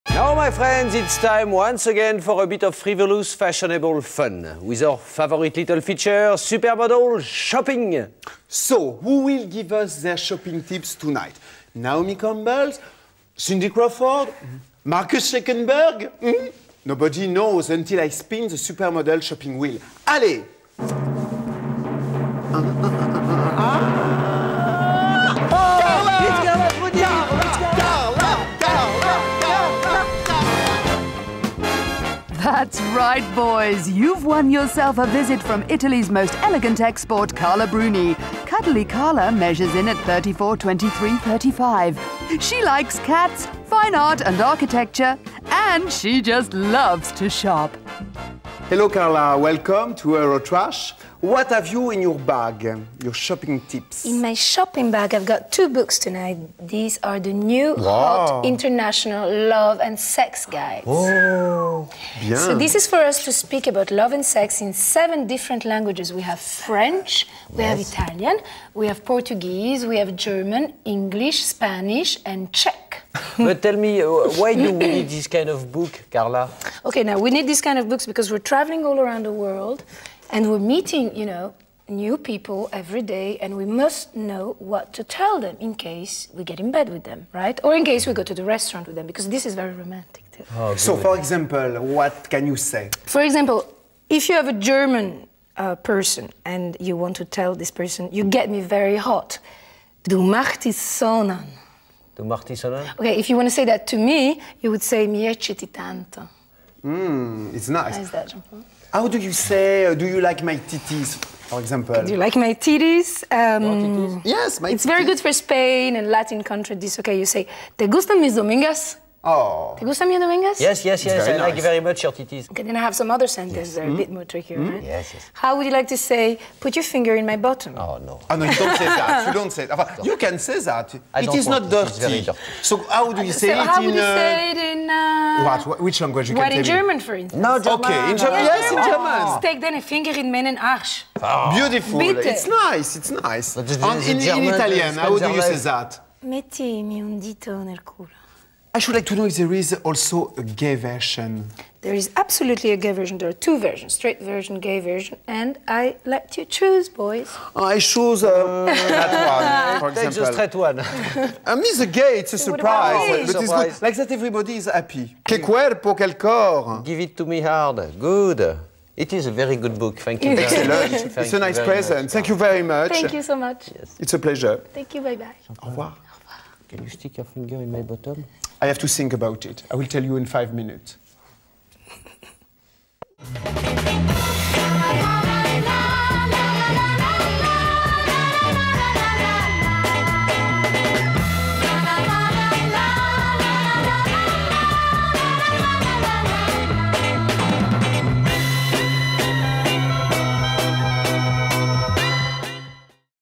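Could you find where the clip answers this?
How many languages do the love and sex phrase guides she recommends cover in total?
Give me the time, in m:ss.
1:04.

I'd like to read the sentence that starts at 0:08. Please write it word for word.
So, who will give us their shopping tips tonight?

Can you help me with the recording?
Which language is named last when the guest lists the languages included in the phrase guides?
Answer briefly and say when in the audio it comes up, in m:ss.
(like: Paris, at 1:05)
Czech, at 1:12.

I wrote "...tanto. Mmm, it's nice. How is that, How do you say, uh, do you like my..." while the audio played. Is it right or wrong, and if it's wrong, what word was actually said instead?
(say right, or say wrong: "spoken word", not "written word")
right.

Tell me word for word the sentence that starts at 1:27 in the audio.
Or in case we go to the restaurant with them because this is very romantic too.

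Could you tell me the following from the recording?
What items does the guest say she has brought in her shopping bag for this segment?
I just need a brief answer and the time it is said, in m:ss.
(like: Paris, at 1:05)
2 books, at 0:55.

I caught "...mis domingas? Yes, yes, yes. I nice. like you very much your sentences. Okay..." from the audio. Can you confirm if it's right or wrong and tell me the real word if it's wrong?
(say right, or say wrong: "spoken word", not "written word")
wrong: "titties", not "sentences".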